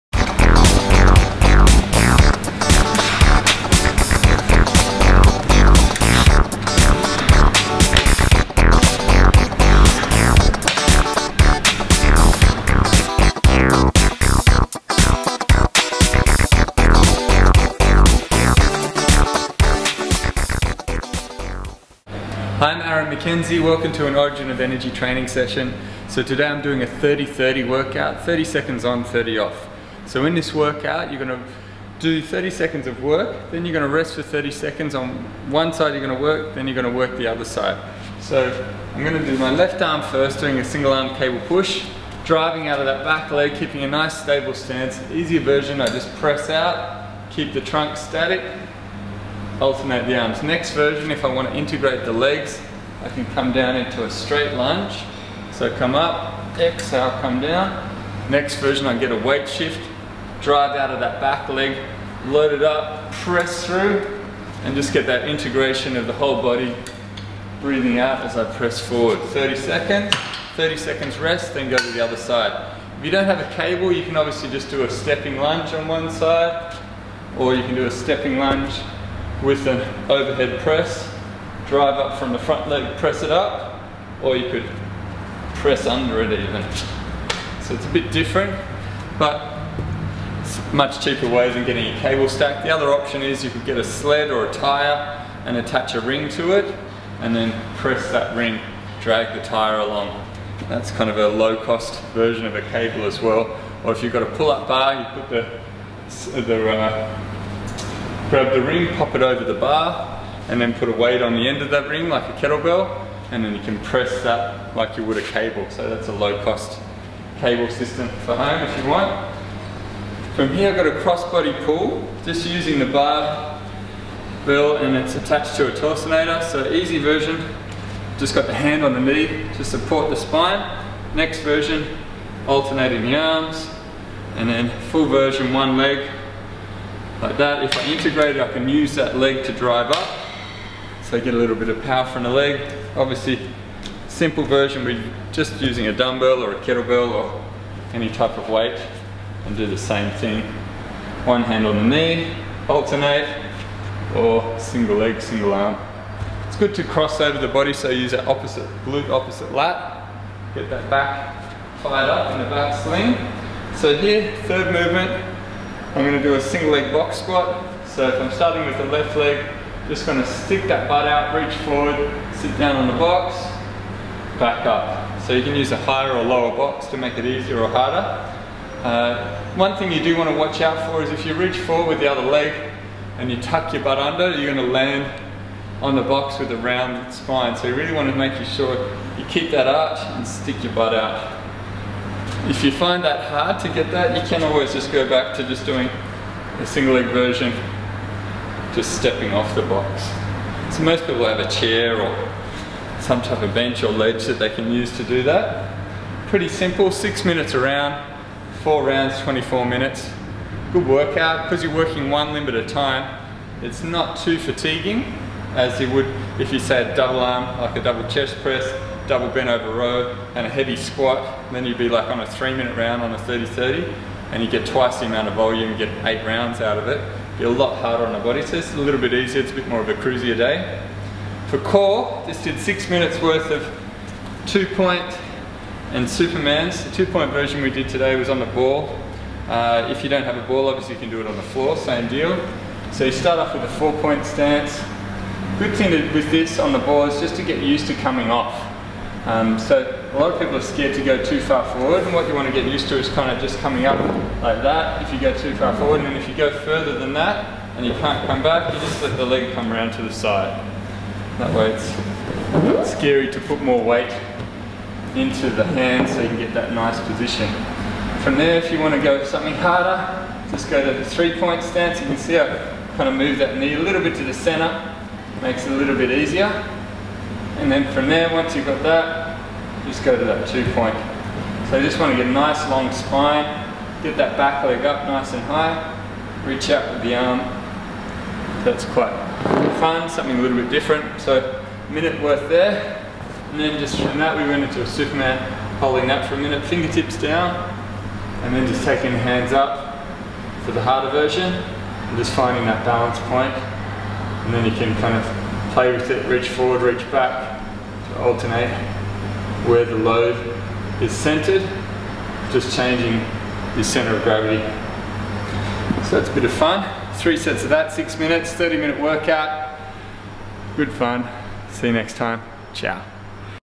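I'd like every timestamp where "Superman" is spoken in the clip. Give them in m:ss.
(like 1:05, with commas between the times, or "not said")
3:56, 4:54.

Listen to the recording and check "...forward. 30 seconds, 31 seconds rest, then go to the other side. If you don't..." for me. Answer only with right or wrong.
wrong.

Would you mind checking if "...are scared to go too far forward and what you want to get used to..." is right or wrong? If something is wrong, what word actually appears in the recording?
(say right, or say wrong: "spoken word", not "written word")
right.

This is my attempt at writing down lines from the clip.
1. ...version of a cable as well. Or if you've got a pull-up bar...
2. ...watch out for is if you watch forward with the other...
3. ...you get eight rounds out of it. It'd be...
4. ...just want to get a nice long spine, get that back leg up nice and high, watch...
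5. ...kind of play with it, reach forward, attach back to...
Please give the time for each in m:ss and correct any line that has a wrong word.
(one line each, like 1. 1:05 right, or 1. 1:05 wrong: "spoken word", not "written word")
1. 1:42 right
2. 3:00 wrong: "reach", not "watch"
3. 3:45 right
4. 4:41 wrong: "reach", not "watch"
5. 5:05 wrong: "reach", not "attach".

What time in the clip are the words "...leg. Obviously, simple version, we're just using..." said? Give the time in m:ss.
2:22.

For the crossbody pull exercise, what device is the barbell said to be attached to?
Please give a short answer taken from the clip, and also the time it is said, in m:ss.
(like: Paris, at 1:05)
torsionator, at 2:05.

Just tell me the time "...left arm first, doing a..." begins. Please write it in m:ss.
0:39.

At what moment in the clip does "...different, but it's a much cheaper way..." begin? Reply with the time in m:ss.
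1:28.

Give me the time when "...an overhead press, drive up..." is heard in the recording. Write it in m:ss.
1:19.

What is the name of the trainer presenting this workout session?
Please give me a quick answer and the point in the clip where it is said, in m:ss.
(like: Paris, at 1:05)
Aaron McKenzie, at 0:22.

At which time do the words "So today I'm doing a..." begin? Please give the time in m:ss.
0:26.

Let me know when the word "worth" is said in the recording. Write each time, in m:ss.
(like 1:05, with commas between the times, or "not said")
3:53, 4:52.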